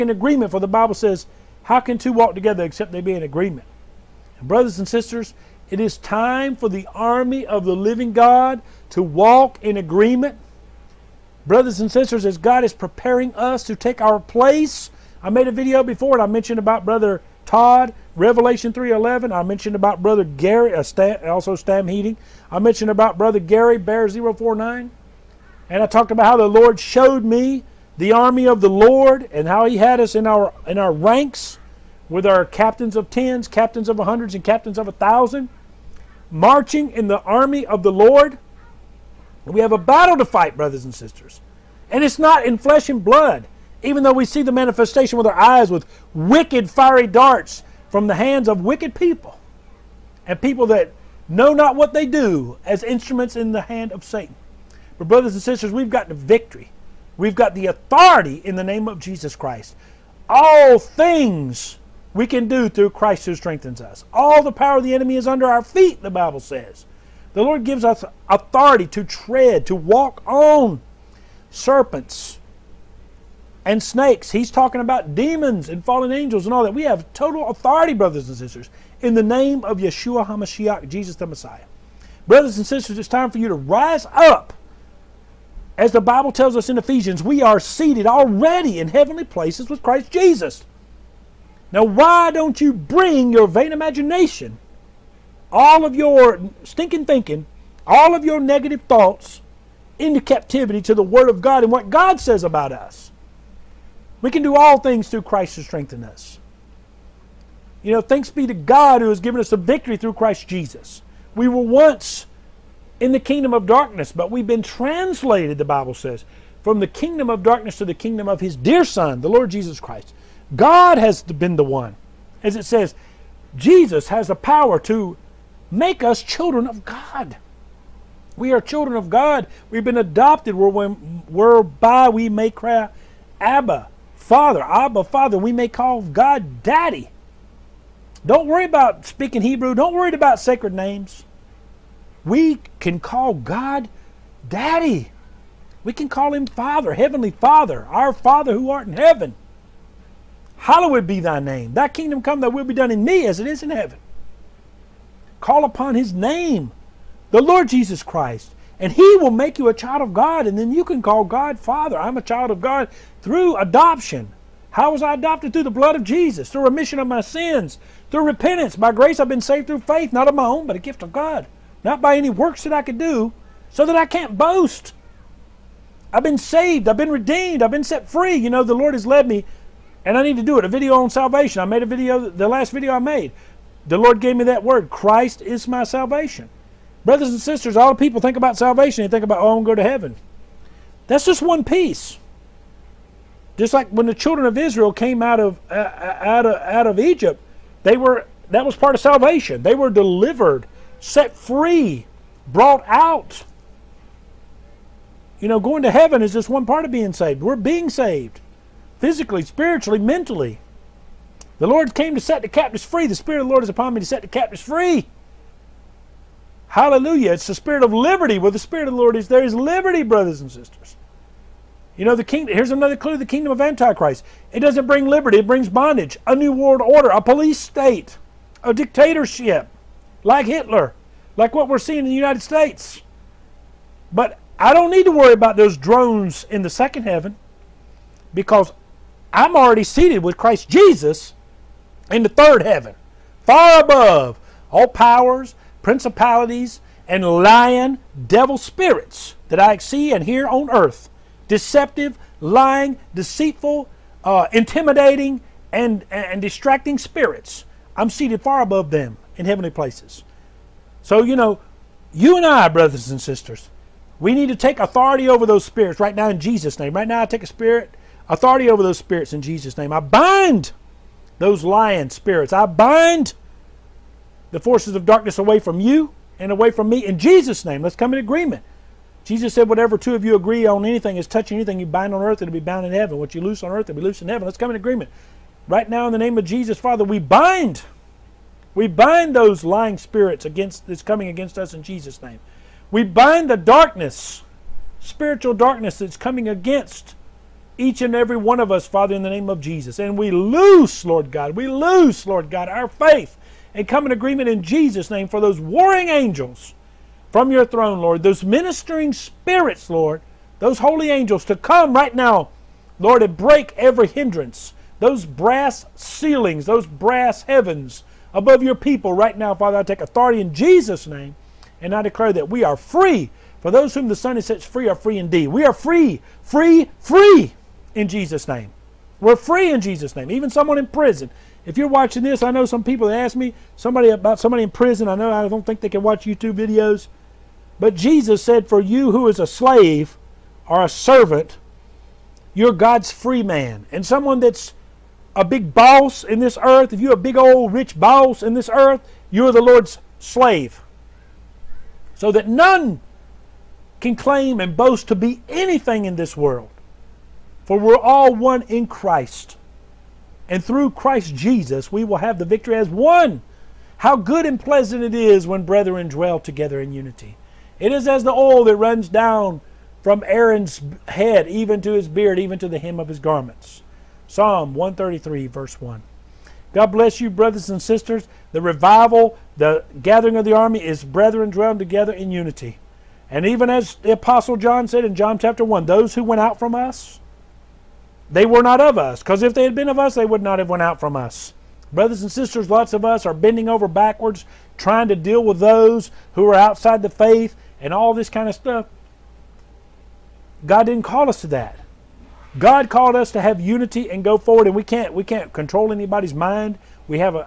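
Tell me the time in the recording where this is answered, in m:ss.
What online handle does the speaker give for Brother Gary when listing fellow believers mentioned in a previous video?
0:23.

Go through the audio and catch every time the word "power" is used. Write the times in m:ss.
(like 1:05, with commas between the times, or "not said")
1:04, 2:04, 4:04.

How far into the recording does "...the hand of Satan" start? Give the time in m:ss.
0:53.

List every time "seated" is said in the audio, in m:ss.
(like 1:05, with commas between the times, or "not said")
1:27, 3:59, 4:18.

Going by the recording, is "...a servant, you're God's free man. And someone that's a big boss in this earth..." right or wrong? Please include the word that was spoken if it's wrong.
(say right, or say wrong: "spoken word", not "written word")
right.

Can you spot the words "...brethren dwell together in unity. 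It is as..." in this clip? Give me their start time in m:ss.
6:05.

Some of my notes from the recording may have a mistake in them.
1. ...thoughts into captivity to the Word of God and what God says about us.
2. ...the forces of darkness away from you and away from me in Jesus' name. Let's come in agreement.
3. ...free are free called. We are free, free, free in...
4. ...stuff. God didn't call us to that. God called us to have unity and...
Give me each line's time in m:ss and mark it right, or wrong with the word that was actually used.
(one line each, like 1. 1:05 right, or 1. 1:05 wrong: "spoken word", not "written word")
1. 1:38 right
2. 4:34 right
3. 5:24 wrong: "indeed", not "called"
4. 6:38 right.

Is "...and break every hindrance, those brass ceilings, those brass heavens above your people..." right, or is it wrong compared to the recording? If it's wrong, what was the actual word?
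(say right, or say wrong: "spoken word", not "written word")
right.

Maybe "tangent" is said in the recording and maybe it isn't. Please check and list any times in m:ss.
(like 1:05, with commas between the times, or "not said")
not said.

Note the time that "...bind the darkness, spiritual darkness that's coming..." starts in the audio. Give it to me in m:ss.
4:53.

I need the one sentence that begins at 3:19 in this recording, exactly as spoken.
They were delivered, set free, brought out.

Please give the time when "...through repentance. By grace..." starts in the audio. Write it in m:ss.
2:48.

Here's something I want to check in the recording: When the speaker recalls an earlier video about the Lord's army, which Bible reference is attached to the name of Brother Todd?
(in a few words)
Revelation 3:11.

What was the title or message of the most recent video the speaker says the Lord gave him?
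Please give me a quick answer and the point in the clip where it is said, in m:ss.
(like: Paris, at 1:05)
Christ is my salvation, at 3:04.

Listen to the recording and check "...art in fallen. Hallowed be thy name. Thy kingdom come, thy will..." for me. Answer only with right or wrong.
wrong.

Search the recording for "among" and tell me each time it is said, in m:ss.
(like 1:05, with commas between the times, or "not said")
not said.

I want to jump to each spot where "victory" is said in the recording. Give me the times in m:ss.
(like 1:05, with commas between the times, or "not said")
0:56, 1:49, 6:02.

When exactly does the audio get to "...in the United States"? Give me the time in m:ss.
3:51.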